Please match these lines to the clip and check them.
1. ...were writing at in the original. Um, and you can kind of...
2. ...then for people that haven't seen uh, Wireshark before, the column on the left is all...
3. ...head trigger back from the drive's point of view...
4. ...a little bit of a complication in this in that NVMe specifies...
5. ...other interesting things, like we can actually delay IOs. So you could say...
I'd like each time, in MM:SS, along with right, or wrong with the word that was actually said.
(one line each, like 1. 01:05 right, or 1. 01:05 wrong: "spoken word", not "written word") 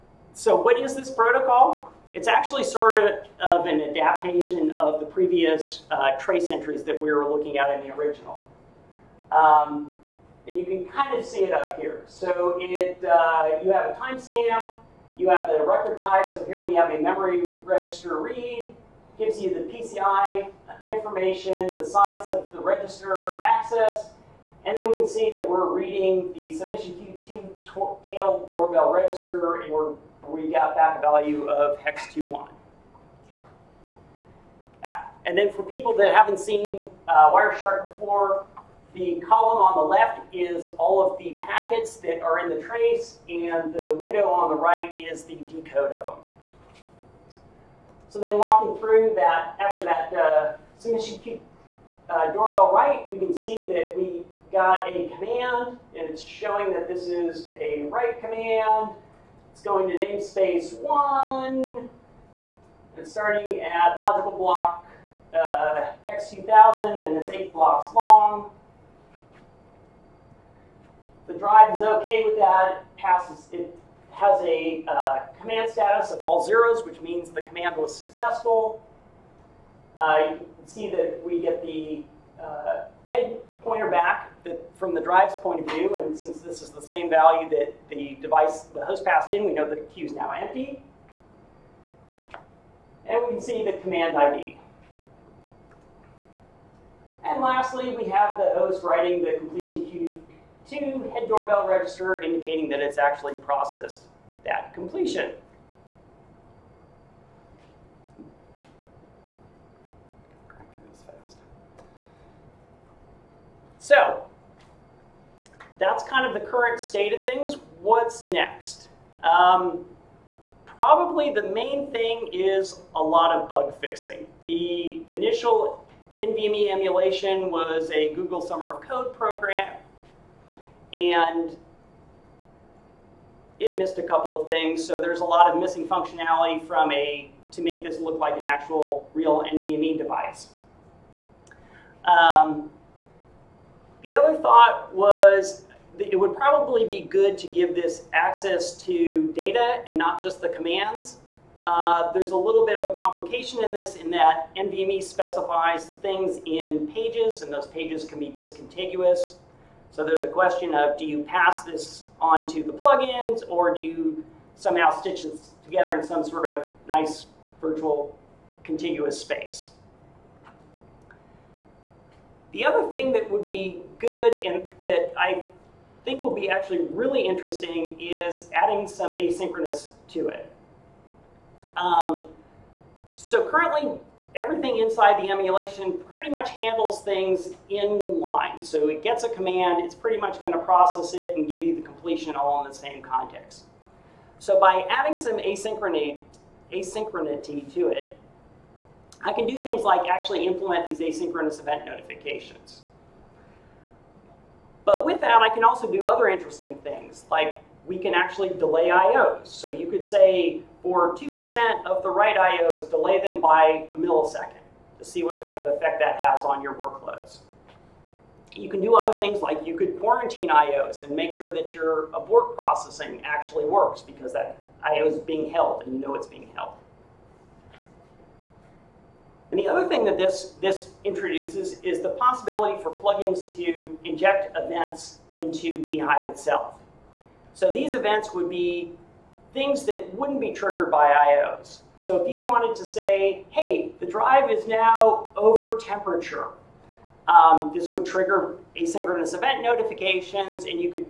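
1. 00:07 wrong: "looking", not "writing"
2. 00:35 right
3. 01:23 wrong: "pointer", not "trigger"
4. 02:32 right
5. 03:26 right.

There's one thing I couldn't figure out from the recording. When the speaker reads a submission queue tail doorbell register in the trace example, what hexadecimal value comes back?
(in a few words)
hex 21.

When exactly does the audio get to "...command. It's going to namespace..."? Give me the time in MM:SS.
00:58.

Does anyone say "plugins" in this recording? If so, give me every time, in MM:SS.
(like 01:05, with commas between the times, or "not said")
02:42, 03:52.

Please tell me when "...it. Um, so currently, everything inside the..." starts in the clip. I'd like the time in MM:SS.
03:00.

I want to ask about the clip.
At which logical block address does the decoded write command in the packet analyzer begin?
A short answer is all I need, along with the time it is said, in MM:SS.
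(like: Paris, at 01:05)
hex 2000, at 01:06.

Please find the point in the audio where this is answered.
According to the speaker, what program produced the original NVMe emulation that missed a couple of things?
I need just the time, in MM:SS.
02:08.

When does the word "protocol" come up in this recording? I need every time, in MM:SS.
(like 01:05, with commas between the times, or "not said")
00:01.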